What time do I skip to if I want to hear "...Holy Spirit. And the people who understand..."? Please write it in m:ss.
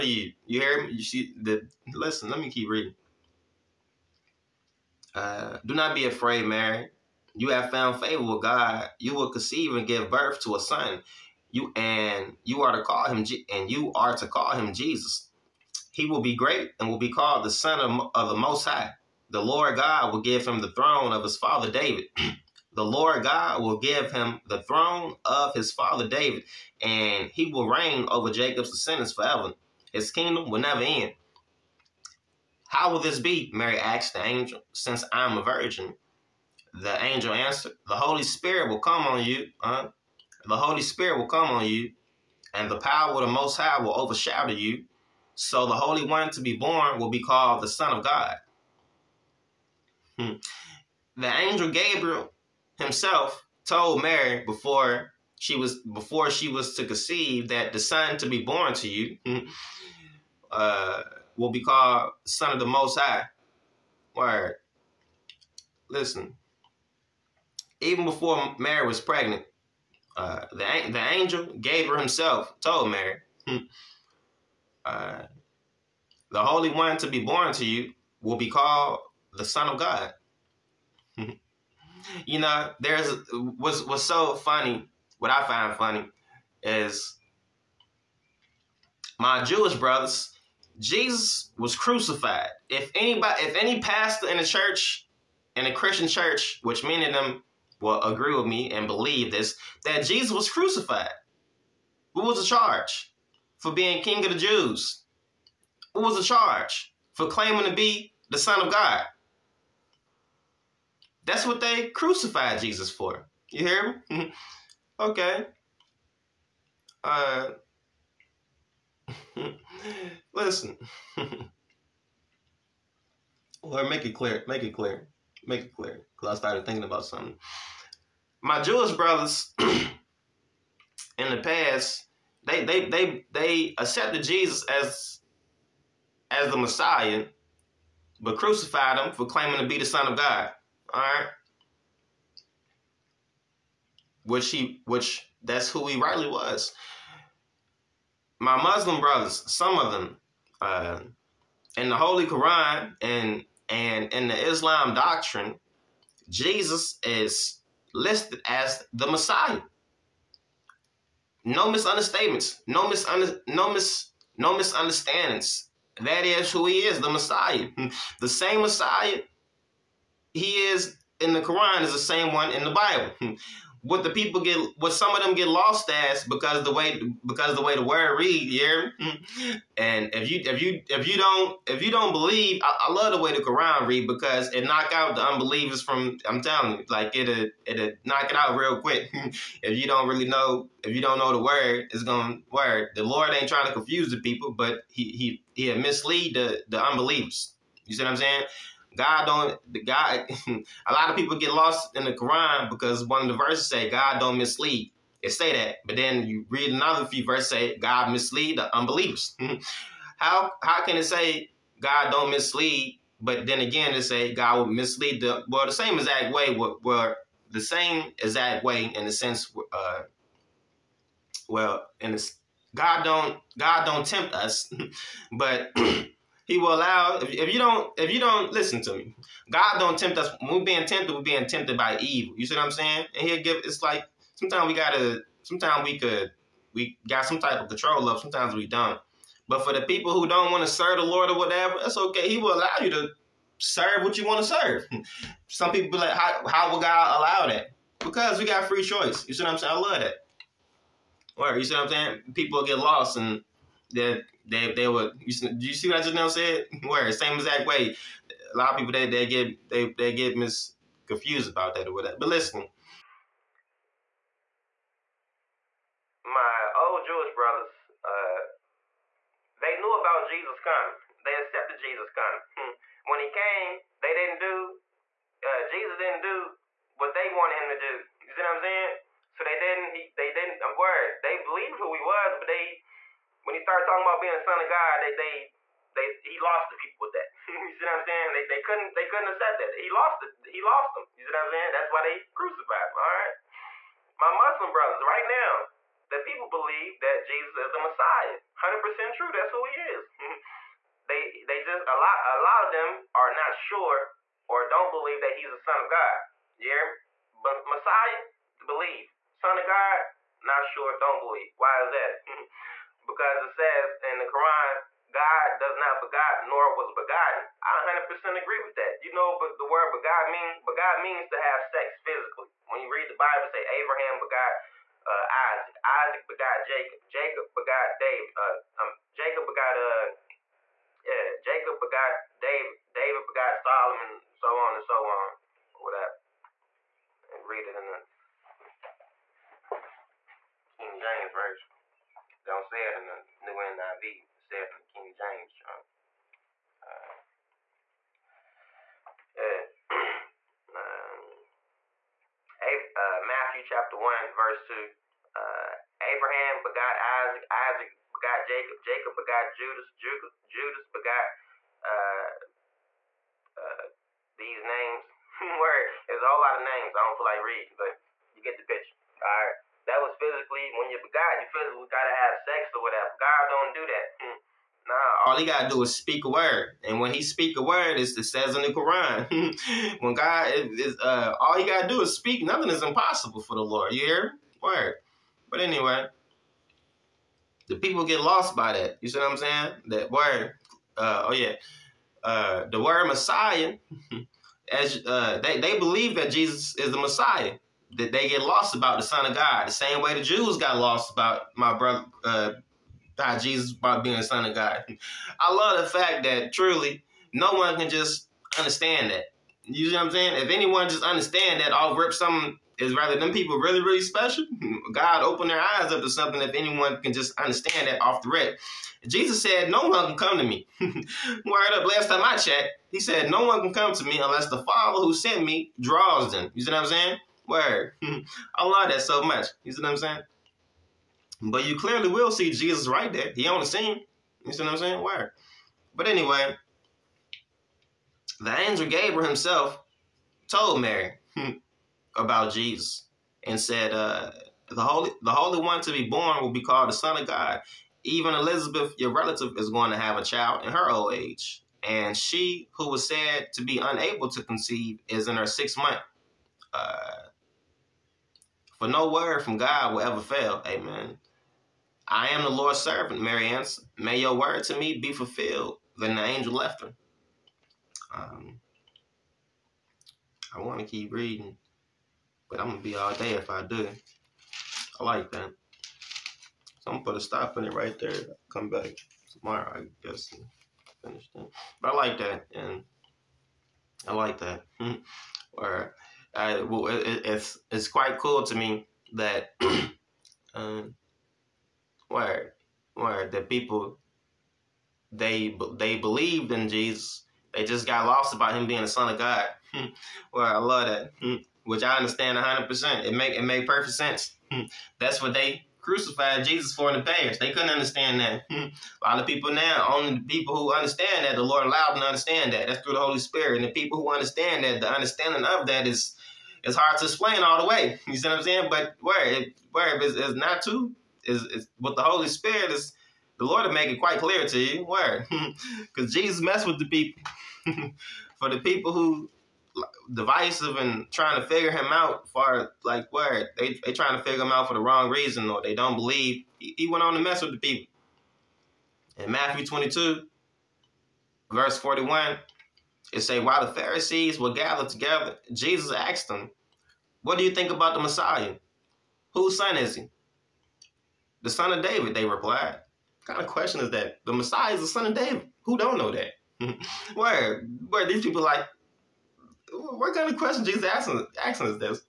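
8:32.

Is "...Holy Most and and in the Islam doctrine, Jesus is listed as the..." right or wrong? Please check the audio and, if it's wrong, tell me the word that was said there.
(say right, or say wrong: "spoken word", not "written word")
wrong: "Quran", not "Most".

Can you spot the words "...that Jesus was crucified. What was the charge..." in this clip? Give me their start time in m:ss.
1:39.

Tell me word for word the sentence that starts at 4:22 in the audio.
But listen, my old Jewish brothers, uh, they knew about Jesus coming.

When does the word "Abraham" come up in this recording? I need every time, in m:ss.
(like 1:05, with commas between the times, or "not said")
5:23, 5:56.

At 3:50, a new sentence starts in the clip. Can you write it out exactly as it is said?
When we're being tempted, we're being tempted by evil.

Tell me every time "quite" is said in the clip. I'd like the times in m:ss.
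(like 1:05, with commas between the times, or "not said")
8:07, 8:43.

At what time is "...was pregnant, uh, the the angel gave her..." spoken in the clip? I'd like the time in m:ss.
1:08.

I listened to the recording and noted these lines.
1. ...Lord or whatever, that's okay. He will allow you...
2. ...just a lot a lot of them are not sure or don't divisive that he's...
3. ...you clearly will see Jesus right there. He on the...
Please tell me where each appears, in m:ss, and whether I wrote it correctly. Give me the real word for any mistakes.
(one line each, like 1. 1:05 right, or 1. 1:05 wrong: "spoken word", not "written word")
1. 4:01 right
2. 5:01 wrong: "believe", not "divisive"
3. 7:11 right.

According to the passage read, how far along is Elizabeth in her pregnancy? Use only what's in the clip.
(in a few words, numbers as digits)
sixth month.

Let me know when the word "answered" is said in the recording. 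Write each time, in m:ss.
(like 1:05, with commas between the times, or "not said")
0:37, 7:43.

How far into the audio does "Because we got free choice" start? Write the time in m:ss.
4:07.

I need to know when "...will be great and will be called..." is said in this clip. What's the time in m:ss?
0:16.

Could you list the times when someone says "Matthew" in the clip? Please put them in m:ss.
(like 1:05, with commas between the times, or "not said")
5:53, 8:59.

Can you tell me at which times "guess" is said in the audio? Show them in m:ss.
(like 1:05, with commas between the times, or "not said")
8:00.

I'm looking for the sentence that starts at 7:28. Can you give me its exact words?
Even Elizabeth, your relative, is going to have a child in her old age.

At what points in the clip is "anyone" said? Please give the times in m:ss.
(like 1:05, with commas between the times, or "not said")
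6:50, 6:56.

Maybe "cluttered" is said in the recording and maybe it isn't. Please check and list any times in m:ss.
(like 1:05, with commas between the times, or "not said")
not said.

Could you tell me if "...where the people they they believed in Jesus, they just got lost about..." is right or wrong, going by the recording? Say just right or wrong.
right.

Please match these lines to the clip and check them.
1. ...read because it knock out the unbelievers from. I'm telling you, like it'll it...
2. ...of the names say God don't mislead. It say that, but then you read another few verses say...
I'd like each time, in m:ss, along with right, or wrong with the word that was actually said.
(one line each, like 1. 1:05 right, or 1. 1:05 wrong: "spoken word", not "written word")
1. 3:03 right
2. 3:23 wrong: "verses", not "names".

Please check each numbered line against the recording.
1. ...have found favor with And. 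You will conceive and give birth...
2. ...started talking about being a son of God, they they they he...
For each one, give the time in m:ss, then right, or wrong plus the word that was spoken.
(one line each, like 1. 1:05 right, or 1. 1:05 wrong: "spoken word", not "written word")
1. 0:07 wrong: "God", not "And"
2. 4:43 right.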